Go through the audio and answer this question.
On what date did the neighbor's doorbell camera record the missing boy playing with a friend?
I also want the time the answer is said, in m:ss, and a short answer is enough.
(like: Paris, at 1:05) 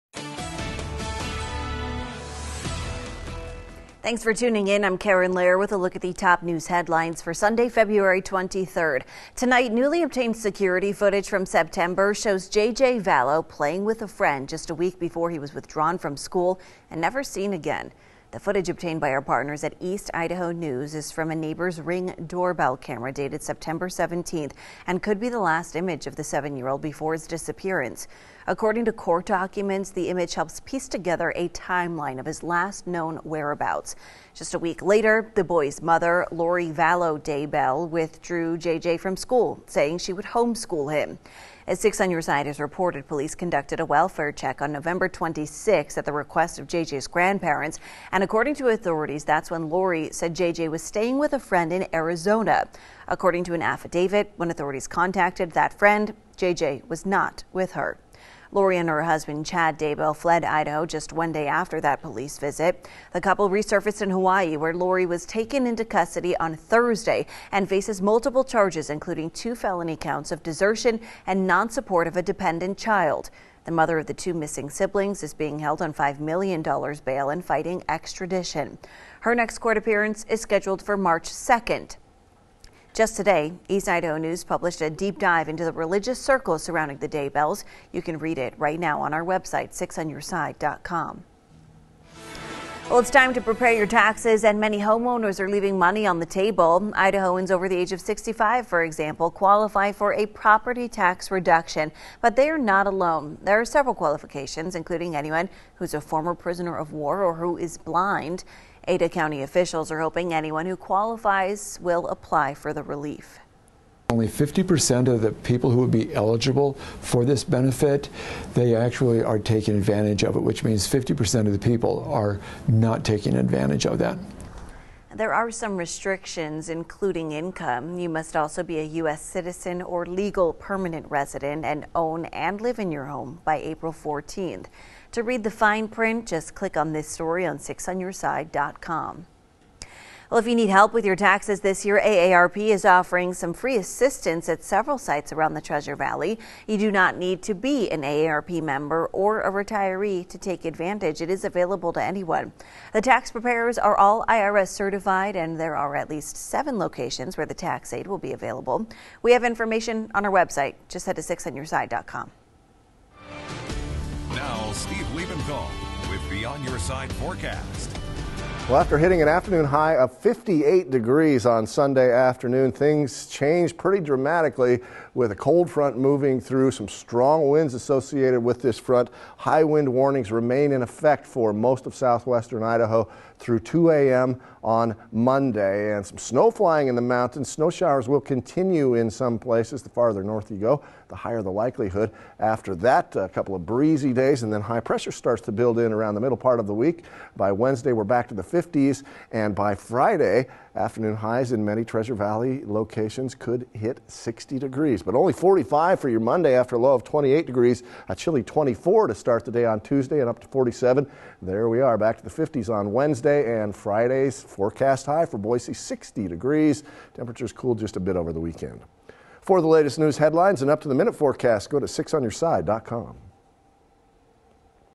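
September 17th, at 0:23.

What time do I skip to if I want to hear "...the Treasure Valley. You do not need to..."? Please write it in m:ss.
2:25.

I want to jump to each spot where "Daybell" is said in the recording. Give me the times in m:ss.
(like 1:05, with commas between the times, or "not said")
0:37, 0:59, 1:27.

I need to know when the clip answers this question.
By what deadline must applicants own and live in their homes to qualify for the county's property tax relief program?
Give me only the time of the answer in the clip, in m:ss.
2:13.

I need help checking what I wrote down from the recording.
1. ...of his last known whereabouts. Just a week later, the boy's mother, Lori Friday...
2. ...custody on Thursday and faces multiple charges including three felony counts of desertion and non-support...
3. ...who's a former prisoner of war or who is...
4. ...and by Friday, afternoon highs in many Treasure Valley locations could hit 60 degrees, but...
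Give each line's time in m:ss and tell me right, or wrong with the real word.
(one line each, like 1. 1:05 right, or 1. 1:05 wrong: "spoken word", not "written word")
1. 0:32 wrong: "Vallow", not "Friday"
2. 1:05 wrong: "two", not "three"
3. 1:45 right
4. 3:19 right.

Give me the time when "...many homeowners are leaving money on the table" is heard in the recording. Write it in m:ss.
1:34.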